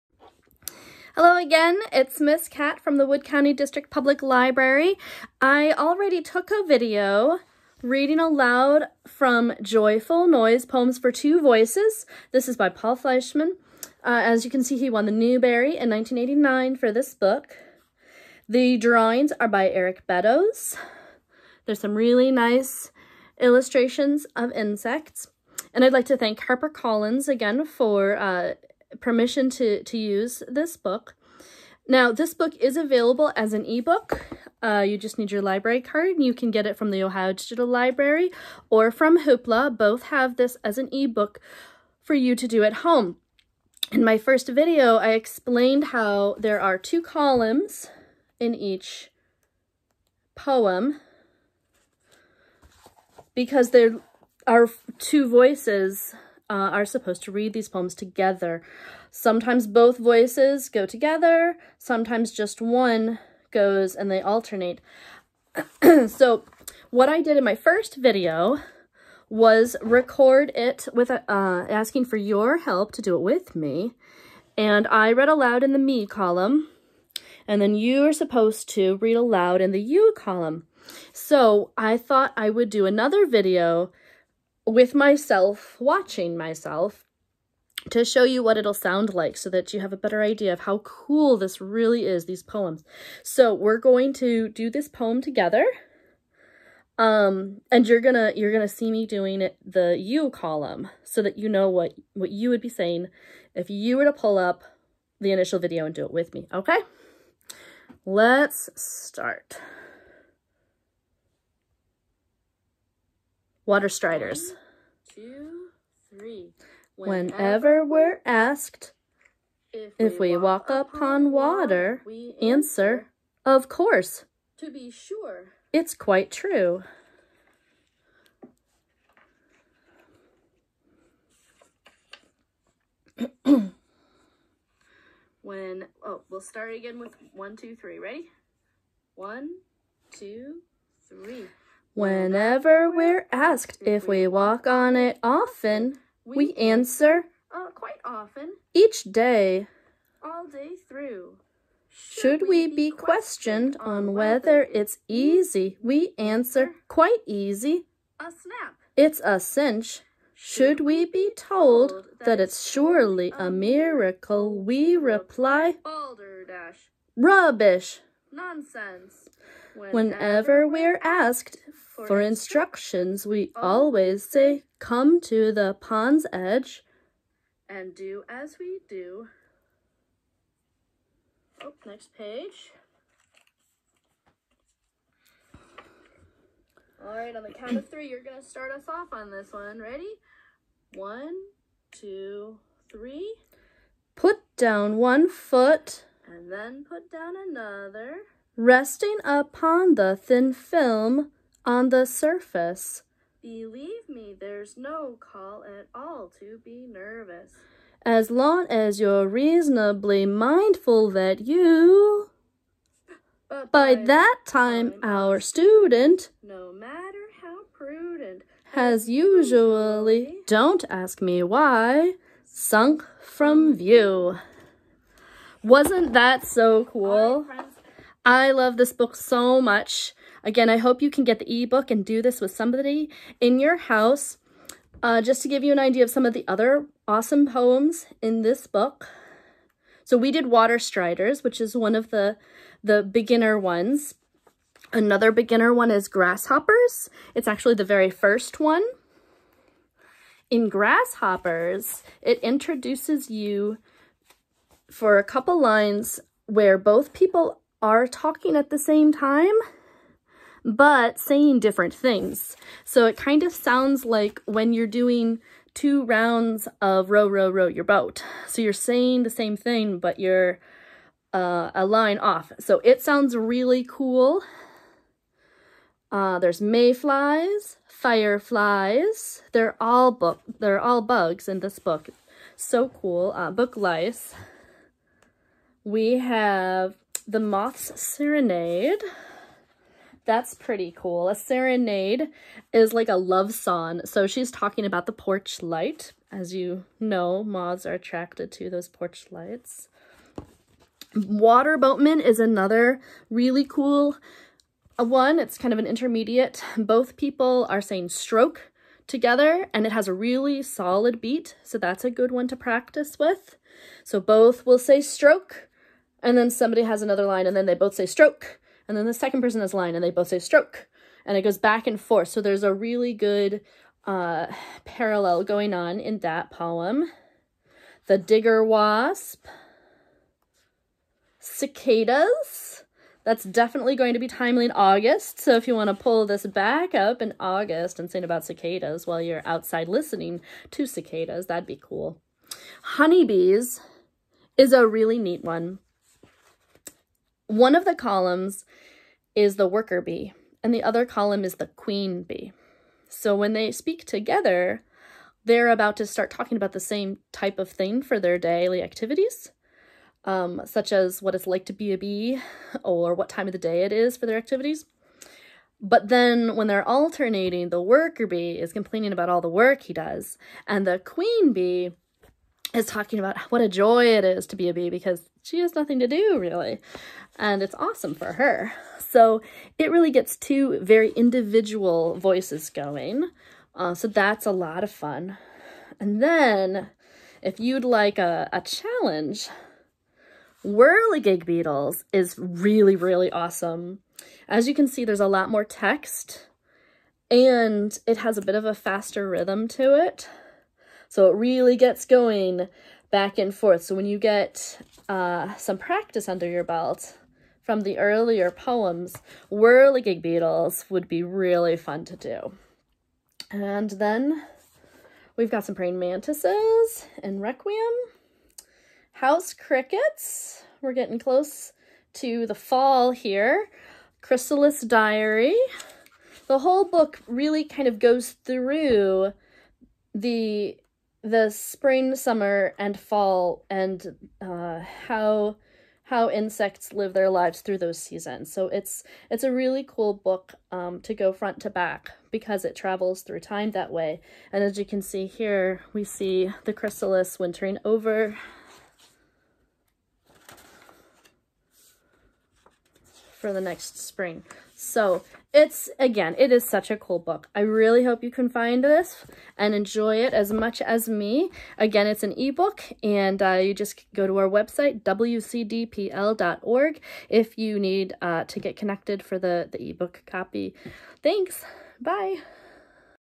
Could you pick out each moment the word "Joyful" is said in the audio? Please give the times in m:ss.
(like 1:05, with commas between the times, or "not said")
0:09.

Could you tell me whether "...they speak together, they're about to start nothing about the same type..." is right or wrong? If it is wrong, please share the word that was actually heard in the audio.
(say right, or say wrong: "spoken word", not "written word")
wrong: "talking", not "nothing".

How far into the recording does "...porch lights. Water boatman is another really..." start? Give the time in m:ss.
4:58.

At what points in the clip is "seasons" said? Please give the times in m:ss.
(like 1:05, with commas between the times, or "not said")
7:17.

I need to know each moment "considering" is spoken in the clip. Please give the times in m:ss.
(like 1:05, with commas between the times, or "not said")
not said.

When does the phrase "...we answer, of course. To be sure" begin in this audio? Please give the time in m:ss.
2:02.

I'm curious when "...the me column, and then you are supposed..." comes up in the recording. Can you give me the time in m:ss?
1:15.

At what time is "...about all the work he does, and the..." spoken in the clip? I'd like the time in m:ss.
6:09.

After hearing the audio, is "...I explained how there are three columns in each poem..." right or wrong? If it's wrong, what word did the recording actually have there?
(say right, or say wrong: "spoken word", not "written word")
wrong: "two", not "three".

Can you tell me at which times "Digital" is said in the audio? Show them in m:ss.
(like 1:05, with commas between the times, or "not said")
0:37.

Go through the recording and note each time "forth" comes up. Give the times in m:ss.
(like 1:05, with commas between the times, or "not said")
5:22, 6:43.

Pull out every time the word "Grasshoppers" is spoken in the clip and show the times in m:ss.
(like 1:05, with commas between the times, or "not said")
4:06, 4:10.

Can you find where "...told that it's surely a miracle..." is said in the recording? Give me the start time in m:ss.
2:41.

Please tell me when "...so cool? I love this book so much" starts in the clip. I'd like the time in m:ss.
3:46.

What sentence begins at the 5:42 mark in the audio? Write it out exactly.
Honeybees is a really neat one.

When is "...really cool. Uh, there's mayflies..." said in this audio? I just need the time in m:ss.
4:33.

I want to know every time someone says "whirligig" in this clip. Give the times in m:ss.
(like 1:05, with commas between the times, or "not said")
6:30, 6:49.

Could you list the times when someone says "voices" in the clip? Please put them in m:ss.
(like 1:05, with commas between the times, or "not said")
0:11, 0:55, 0:59, 6:22.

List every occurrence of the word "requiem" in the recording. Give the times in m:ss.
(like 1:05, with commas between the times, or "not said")
6:57.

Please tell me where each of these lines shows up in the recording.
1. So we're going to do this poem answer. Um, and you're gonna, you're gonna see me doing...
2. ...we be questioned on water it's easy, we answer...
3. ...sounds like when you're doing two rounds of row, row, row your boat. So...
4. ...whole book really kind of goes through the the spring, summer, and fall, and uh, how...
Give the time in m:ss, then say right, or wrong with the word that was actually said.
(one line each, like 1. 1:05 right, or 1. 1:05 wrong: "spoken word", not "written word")
1. 1:33 wrong: "together", not "answer"
2. 2:32 wrong: "whether", not "water"
3. 4:23 right
4. 7:06 right.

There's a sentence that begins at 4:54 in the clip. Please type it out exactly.
So she's talking about the porch light.